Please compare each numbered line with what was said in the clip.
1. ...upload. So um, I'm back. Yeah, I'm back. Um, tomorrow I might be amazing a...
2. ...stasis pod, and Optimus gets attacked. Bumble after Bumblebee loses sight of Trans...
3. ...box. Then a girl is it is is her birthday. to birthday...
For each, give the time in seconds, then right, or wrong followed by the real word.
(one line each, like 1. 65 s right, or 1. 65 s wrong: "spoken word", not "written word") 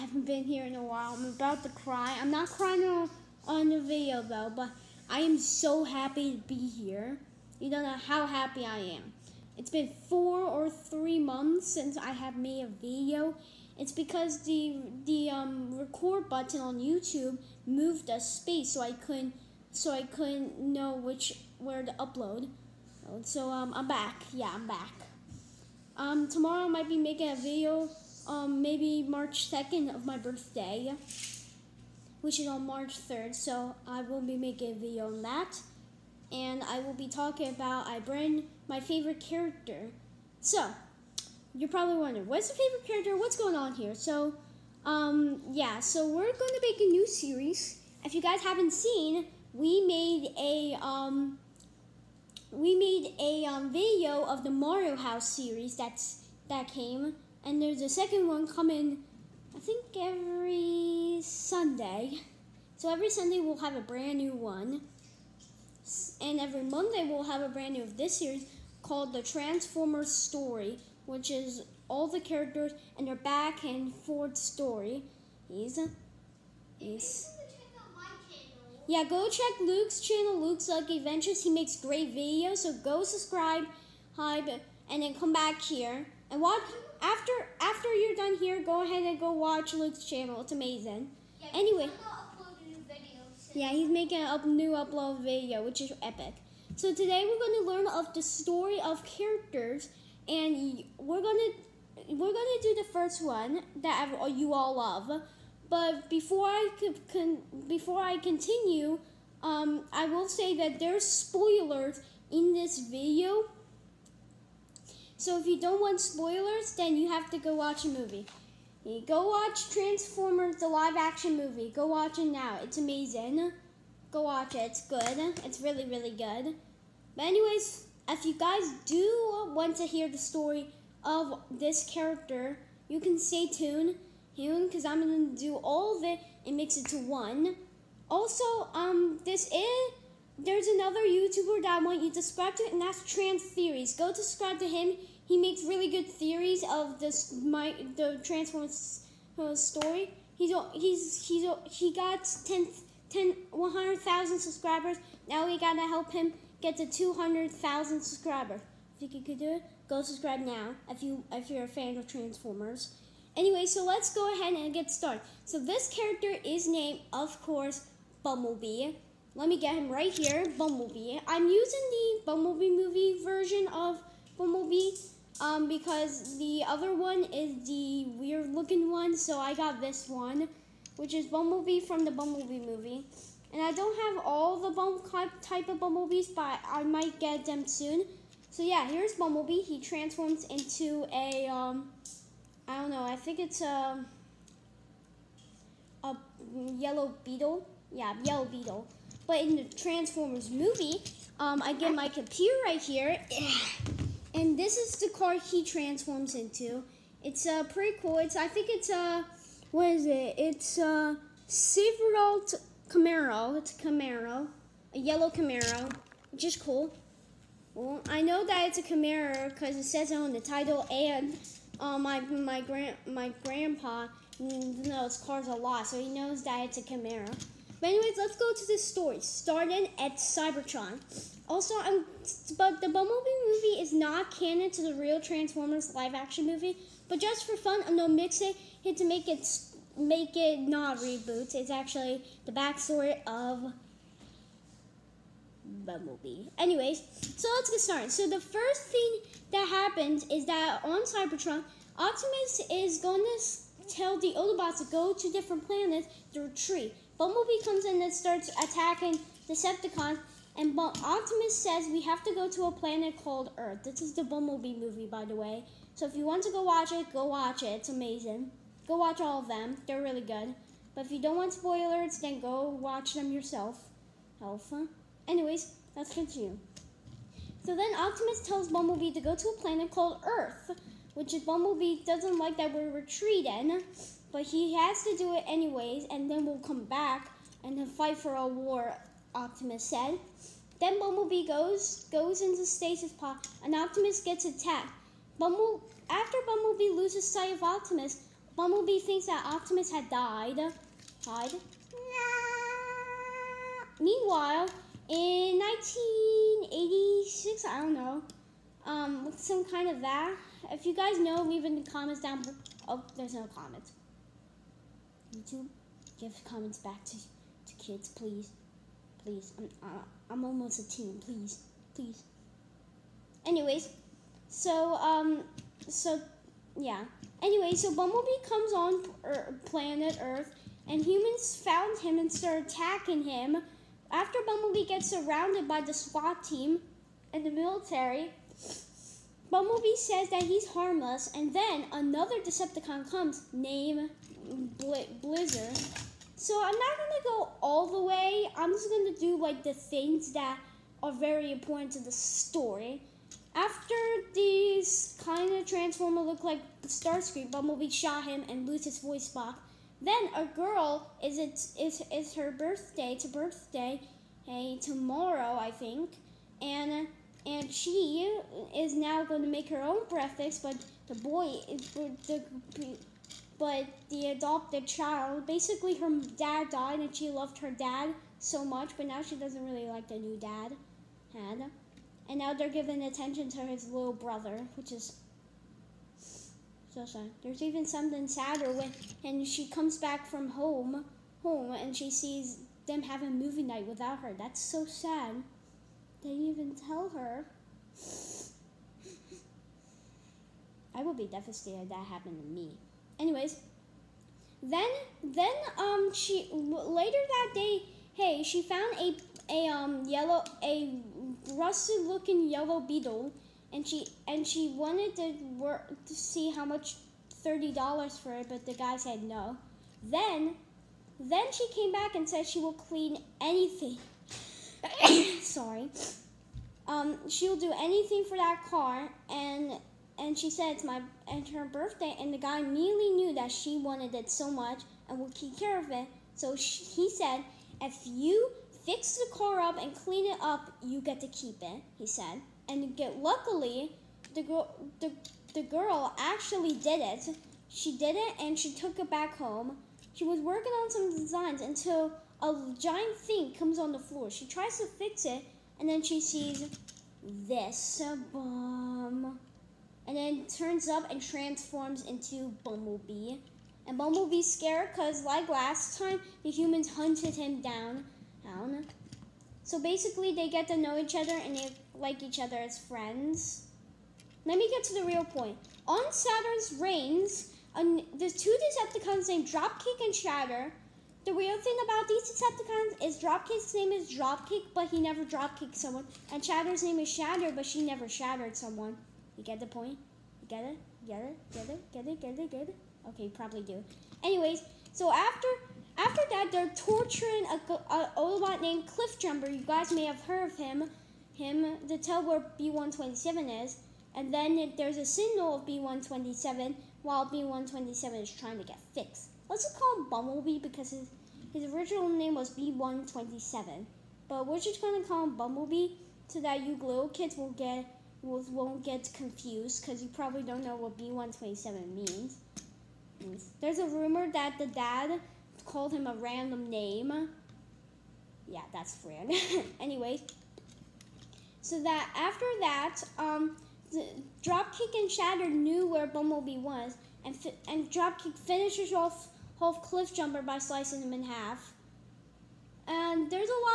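1. 21 s wrong: "making", not "amazing"
2. 292 s wrong: "Optimus", not "Trans"
3. 359 s right.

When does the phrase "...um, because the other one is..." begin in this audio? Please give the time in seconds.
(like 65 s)
175 s.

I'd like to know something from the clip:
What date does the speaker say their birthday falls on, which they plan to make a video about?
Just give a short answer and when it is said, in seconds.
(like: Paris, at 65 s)
March 3rd, at 32 s.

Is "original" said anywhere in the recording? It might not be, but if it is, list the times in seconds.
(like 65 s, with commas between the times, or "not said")
511 s.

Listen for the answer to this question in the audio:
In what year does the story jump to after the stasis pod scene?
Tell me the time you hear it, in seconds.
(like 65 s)
305 s.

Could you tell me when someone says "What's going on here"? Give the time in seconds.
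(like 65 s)
43 s.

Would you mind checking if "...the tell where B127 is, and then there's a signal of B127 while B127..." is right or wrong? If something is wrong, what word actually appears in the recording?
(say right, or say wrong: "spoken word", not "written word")
right.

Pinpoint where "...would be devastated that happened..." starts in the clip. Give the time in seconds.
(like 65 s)
401 s.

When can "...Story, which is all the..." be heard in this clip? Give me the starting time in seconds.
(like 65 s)
70 s.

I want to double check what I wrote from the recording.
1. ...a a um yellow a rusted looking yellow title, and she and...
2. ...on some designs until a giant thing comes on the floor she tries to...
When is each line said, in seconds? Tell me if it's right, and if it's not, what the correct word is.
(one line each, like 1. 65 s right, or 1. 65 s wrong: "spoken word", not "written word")
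1. 408 s wrong: "beetle", not "title"
2. 450 s right.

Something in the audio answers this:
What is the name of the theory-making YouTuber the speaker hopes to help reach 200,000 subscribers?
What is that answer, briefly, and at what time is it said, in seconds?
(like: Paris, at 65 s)
Trans Theories, at 143 s.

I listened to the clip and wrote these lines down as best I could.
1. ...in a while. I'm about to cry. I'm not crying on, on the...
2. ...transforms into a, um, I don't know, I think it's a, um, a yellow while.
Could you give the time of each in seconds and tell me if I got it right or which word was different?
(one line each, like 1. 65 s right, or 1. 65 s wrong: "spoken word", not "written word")
1. 0 s right
2. 189 s wrong: "beetle", not "while".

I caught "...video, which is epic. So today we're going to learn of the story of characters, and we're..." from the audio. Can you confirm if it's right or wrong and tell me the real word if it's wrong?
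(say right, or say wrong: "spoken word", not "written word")
right.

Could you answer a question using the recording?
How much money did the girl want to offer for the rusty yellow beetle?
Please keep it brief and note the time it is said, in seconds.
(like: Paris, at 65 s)
$30, at 417 s.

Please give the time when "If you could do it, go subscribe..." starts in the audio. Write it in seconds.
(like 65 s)
158 s.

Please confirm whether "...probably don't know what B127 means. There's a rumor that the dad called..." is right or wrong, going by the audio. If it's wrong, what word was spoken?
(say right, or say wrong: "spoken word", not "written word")
right.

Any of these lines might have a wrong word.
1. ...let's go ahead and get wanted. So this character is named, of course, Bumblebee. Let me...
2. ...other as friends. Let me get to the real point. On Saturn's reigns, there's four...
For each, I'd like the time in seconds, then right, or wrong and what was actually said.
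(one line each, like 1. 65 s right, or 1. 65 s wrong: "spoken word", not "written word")
1. 163 s wrong: "started", not "wanted"
2. 472 s wrong: "two", not "four".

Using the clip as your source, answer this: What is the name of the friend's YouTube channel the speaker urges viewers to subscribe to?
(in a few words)
Luke's Lucky Adventures.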